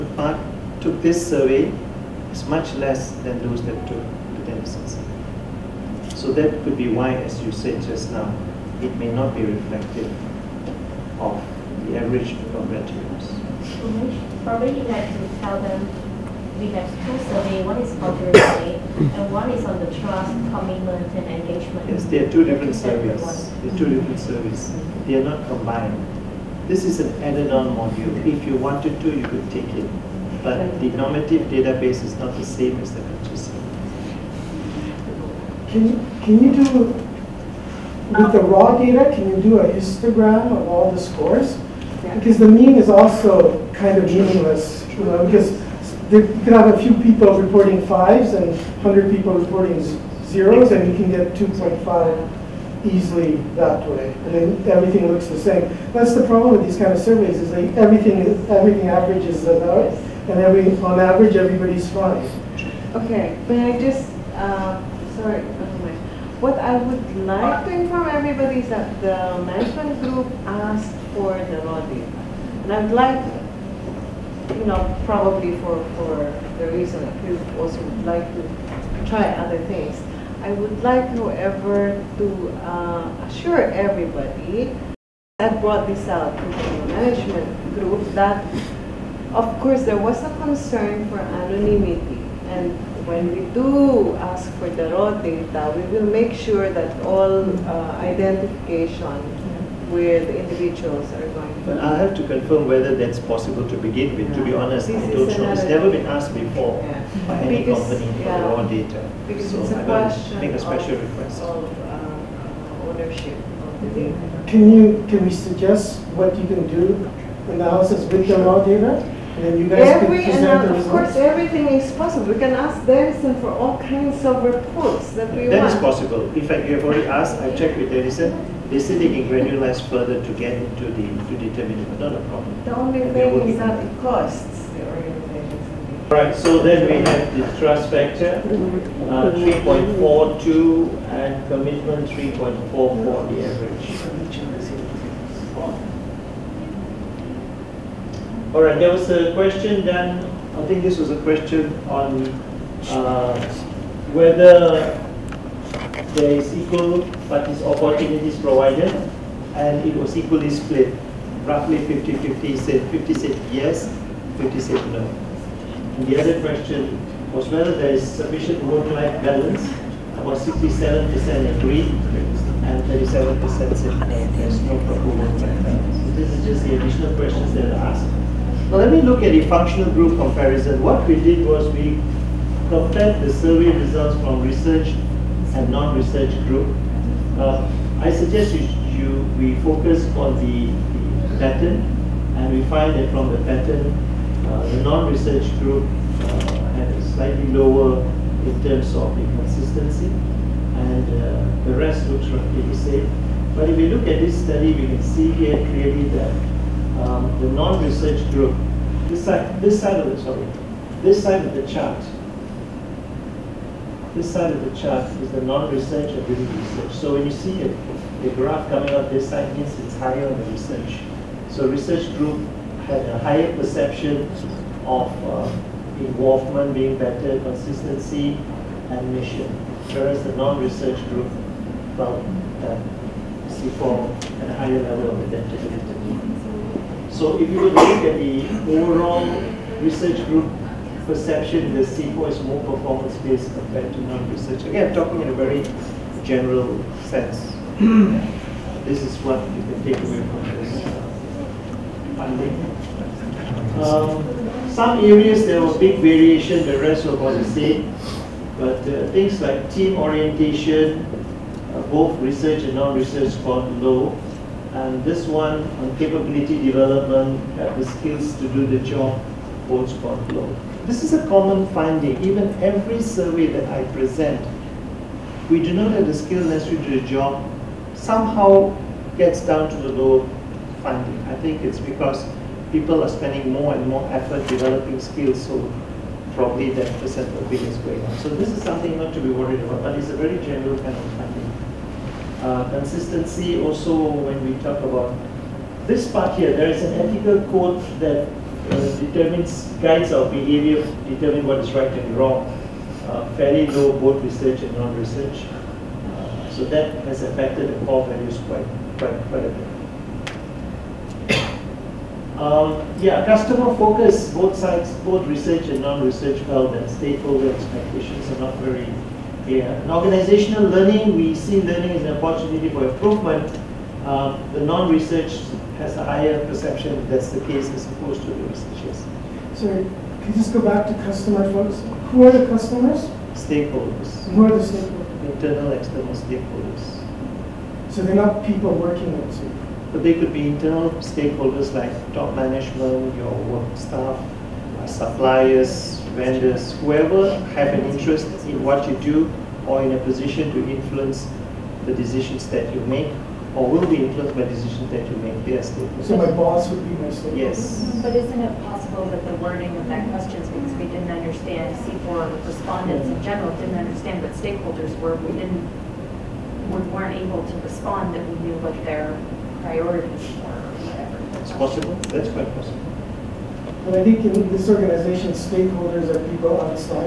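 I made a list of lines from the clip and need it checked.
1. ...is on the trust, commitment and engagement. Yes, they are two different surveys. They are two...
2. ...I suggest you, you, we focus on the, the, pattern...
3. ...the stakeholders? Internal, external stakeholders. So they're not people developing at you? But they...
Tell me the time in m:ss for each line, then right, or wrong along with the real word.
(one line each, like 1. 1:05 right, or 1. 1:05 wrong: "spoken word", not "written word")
1. 0:19 right
2. 3:07 right
3. 5:34 wrong: "working", not "developing".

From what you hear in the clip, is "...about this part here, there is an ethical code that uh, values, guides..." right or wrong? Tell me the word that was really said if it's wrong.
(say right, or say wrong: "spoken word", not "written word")
wrong: "determines", not "values".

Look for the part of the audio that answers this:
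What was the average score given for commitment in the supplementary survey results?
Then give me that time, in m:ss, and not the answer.
2:22.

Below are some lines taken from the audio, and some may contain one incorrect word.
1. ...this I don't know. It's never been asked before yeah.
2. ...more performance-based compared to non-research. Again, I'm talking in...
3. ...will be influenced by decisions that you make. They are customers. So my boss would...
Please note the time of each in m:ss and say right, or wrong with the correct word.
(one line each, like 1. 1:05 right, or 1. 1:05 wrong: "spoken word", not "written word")
1. 1:44 right
2. 4:02 right
3. 5:53 wrong: "stakeholders", not "customers".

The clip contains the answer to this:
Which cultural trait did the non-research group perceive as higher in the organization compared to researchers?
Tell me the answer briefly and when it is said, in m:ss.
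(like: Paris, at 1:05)
identity, at 3:55.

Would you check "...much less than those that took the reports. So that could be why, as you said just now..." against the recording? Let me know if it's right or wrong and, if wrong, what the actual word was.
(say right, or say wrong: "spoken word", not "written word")
wrong: "deficits", not "reports".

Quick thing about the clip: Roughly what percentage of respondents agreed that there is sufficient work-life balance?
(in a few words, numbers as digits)
67%.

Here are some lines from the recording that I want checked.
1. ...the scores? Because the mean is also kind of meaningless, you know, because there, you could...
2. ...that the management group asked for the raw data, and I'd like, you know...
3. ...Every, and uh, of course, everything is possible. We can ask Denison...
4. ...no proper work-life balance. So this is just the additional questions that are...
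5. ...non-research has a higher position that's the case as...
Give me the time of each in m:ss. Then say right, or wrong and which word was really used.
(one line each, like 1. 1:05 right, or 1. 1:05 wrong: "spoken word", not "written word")
1. 0:40 right
2. 1:08 right
3. 2:00 right
4. 2:54 right
5. 5:24 wrong: "perception", not "position".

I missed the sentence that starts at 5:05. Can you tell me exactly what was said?
Uh, so that has affected the core values quite, quite, quite a bit.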